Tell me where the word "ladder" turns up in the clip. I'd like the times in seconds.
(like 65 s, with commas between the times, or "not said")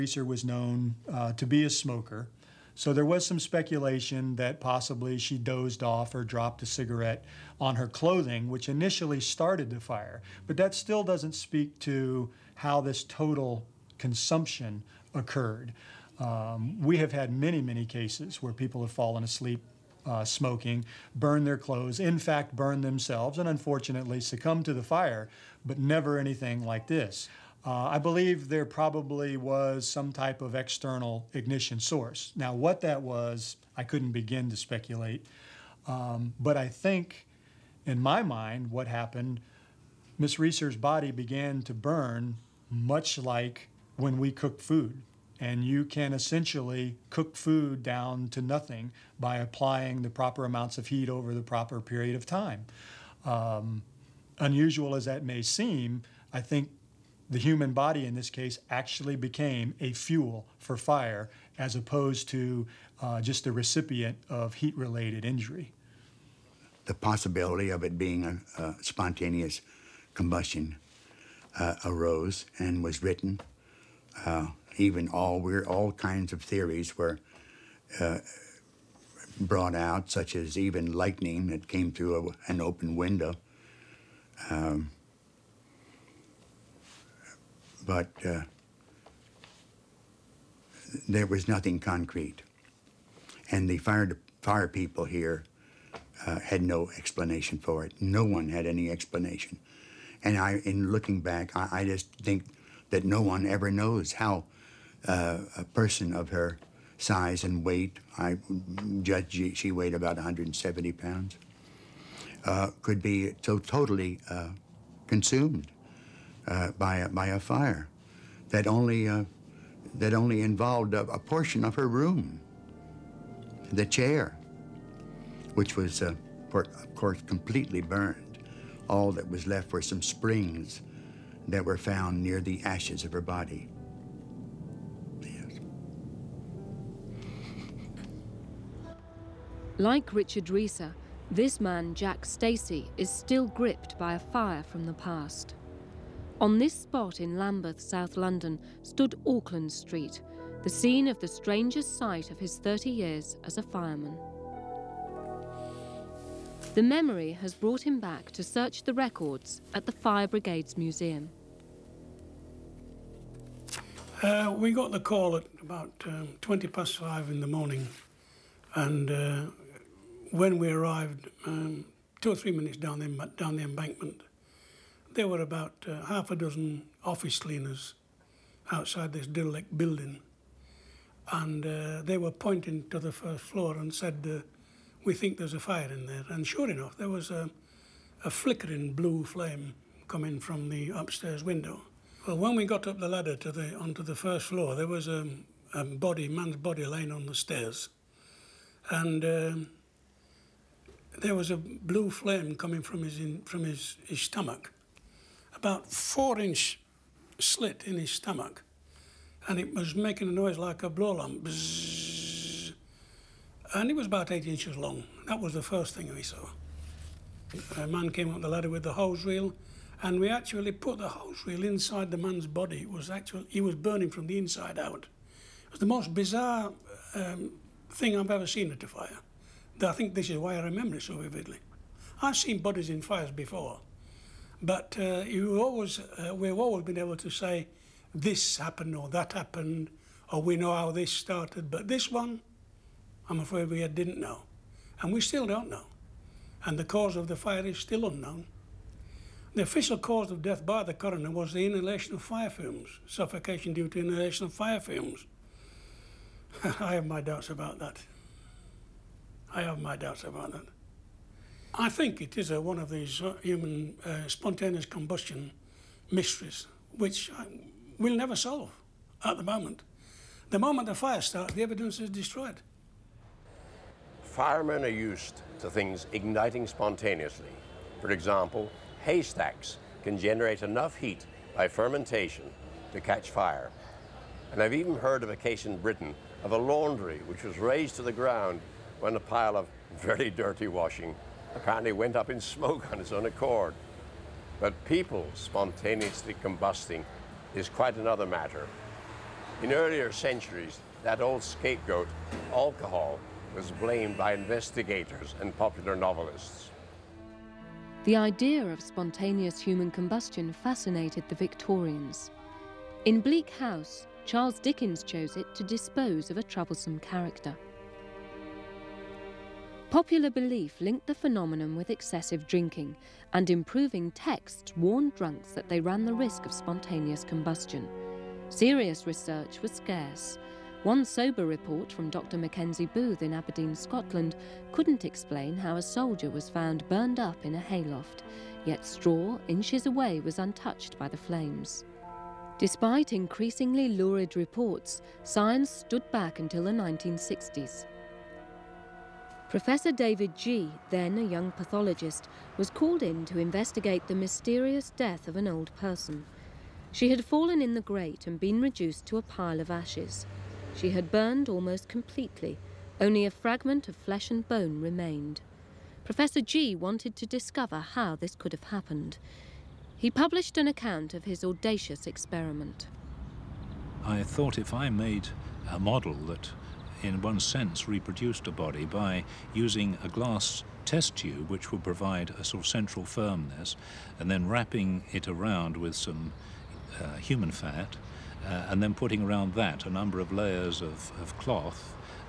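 193 s, 218 s.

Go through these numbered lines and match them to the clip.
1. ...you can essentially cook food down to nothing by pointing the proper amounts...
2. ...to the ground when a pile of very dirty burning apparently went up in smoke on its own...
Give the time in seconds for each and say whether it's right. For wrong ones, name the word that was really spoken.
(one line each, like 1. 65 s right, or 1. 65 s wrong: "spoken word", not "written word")
1. 45 s wrong: "applying", not "pointing"
2. 287 s wrong: "washing", not "burning".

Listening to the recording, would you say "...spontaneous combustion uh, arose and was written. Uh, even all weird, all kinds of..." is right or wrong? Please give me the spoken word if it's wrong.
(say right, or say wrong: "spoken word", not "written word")
right.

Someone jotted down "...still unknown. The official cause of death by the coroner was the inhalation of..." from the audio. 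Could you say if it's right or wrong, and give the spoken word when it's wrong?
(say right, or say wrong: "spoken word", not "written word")
right.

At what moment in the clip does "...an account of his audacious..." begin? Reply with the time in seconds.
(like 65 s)
370 s.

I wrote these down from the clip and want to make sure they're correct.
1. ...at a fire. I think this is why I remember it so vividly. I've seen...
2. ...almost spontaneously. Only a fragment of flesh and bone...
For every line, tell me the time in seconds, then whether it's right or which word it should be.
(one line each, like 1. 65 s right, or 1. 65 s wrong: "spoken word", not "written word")
1. 228 s right
2. 361 s wrong: "completely", not "spontaneously".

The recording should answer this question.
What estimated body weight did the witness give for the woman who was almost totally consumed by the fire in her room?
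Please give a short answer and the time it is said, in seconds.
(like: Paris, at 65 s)
170 pounds, at 110 s.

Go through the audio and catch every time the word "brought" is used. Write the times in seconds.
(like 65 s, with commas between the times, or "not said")
79 s, 157 s.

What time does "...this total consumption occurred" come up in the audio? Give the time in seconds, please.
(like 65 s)
12 s.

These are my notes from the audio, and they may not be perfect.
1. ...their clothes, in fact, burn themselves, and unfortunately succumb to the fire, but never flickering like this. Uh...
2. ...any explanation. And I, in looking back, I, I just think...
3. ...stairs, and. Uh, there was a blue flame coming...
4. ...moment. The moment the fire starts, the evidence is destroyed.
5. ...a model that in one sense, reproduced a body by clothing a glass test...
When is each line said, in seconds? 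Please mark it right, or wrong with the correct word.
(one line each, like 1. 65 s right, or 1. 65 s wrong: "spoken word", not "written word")
1. 21 s wrong: "anything", not "flickering"
2. 98 s right
3. 197 s right
4. 269 s right
5. 375 s wrong: "using", not "clothing".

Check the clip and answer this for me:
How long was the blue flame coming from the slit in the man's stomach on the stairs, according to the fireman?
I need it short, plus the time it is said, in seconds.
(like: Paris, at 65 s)
8 inches, at 214 s.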